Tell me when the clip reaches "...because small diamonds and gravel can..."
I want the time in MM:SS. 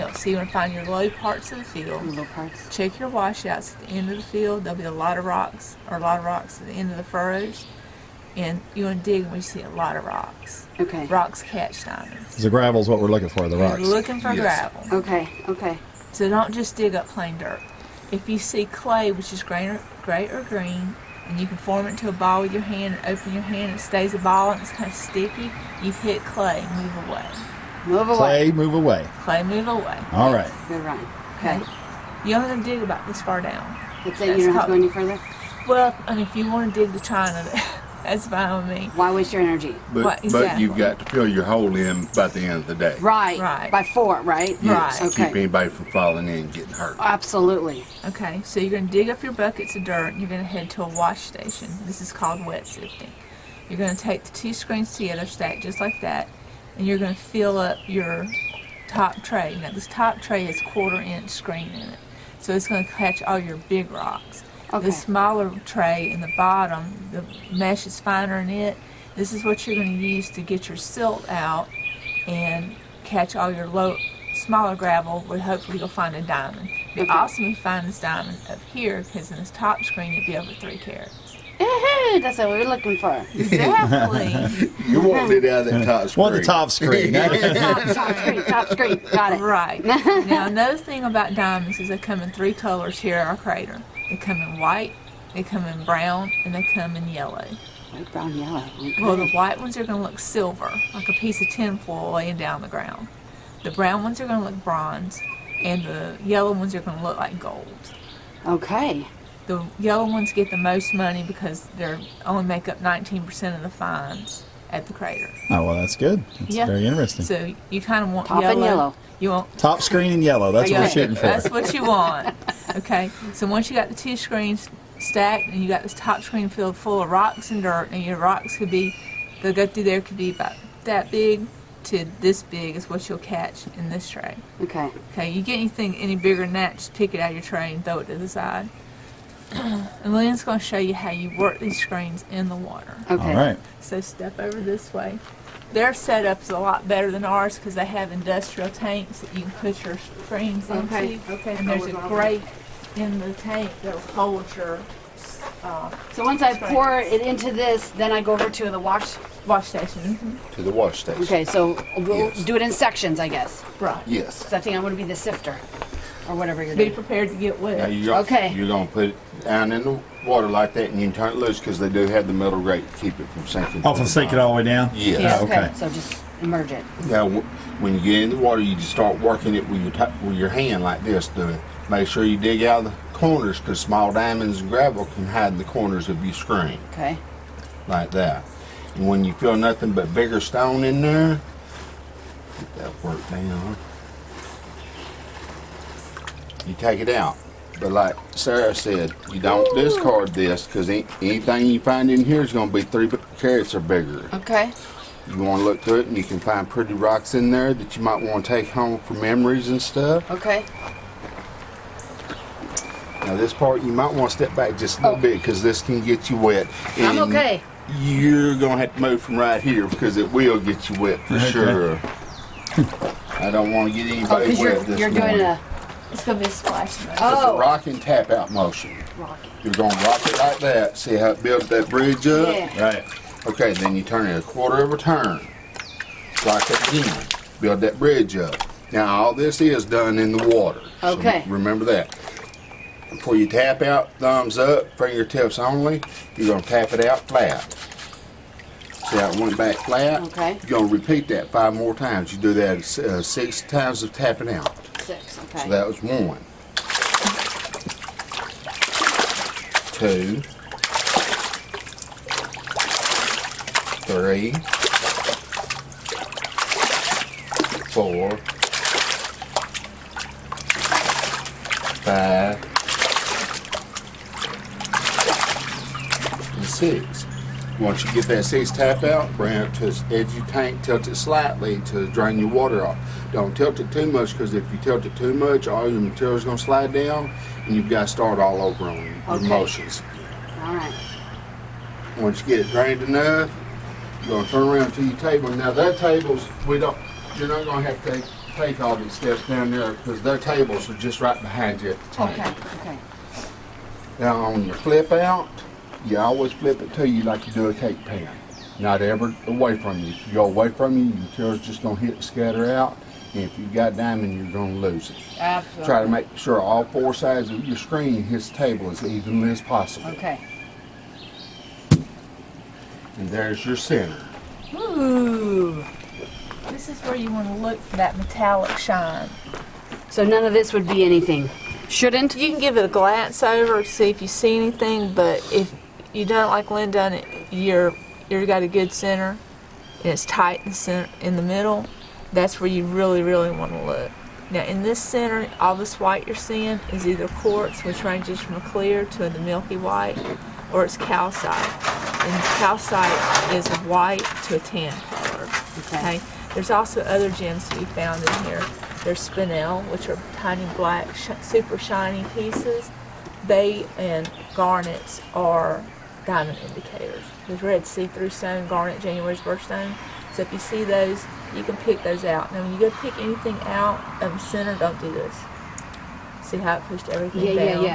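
03:03.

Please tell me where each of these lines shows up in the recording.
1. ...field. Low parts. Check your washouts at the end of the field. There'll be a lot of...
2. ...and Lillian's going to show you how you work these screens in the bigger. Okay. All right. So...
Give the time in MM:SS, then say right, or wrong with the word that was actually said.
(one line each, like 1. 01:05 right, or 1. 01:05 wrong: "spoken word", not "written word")
1. 00:01 right
2. 02:19 wrong: "water", not "bigger".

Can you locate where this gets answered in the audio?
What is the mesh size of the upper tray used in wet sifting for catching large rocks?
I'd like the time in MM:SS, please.
01:00.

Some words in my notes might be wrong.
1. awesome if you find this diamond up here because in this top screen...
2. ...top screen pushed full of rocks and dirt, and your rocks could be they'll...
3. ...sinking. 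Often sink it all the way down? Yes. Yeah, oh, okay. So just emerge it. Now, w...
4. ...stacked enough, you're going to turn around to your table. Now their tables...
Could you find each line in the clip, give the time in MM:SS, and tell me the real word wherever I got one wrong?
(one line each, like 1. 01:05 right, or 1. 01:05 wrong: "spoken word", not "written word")
1. 01:17 right
2. 02:05 wrong: "filled", not "pushed"
3. 02:53 right
4. 04:52 wrong: "drained", not "stacked".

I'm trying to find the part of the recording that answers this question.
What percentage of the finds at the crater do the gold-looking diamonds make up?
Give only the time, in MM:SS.
01:52.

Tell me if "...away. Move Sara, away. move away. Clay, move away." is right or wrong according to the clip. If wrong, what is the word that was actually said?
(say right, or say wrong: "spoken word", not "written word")
wrong: "Clay", not "Sara".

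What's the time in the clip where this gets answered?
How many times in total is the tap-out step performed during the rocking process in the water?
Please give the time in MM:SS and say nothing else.
04:13.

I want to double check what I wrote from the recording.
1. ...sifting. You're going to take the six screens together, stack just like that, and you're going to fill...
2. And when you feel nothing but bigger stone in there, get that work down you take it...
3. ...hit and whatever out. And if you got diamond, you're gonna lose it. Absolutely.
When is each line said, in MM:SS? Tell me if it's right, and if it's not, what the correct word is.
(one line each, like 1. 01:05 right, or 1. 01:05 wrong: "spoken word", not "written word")
1. 00:52 wrong: "two", not "six"
2. 03:08 right
3. 05:11 wrong: "scatter", not "whatever".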